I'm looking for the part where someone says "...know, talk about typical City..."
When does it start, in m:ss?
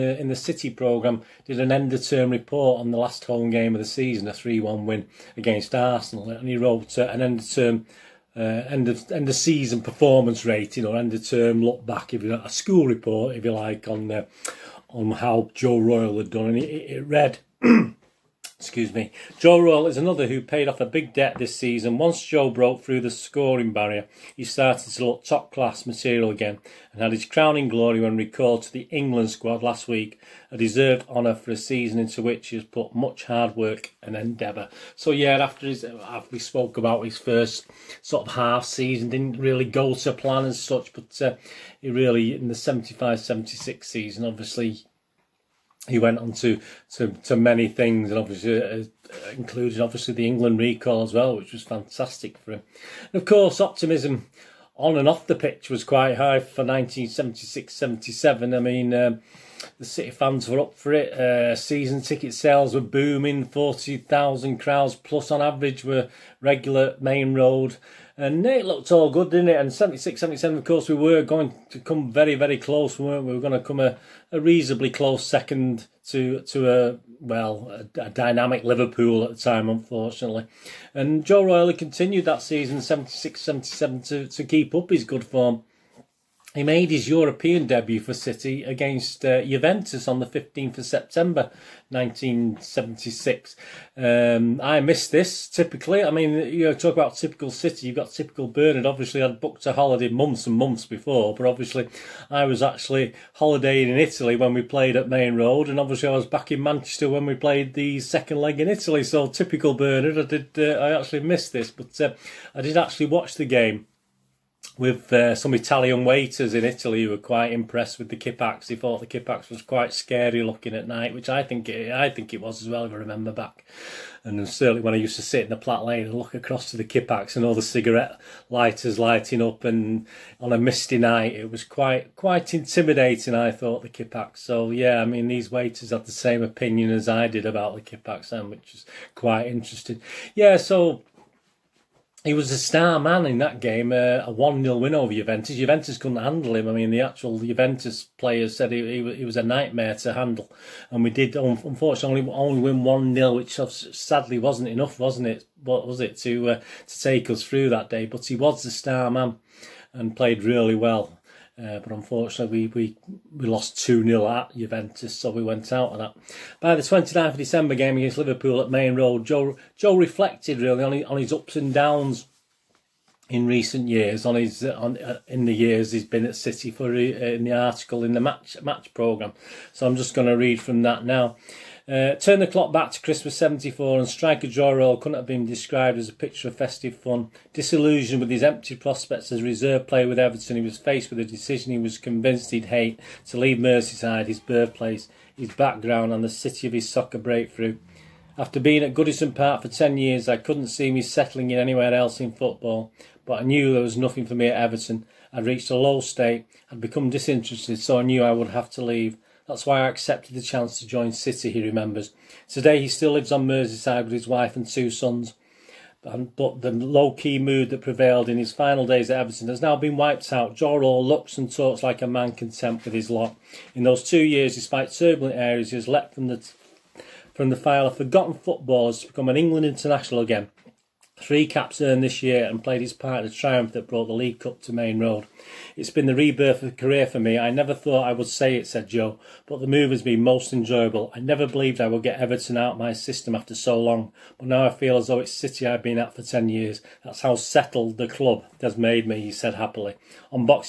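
1:36.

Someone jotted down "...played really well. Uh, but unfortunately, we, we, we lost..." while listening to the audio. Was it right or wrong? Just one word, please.
right.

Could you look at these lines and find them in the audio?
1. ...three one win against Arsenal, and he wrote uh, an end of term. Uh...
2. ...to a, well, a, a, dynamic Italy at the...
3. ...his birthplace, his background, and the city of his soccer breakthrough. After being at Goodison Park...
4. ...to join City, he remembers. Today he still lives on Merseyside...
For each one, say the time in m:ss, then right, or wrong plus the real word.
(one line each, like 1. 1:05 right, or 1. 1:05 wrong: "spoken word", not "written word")
1. 0:04 right
2. 1:16 wrong: "Liverpool", not "Italy"
3. 3:14 right
4. 3:30 right.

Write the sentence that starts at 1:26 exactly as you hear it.
He made his European debut for City against uh, Juventus on the 15th of September 1976.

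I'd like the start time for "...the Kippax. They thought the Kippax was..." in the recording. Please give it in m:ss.
1:58.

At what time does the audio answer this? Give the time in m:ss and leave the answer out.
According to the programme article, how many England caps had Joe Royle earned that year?
3:51.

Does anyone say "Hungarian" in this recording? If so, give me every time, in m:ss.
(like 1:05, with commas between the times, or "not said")
not said.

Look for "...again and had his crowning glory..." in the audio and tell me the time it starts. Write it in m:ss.
0:26.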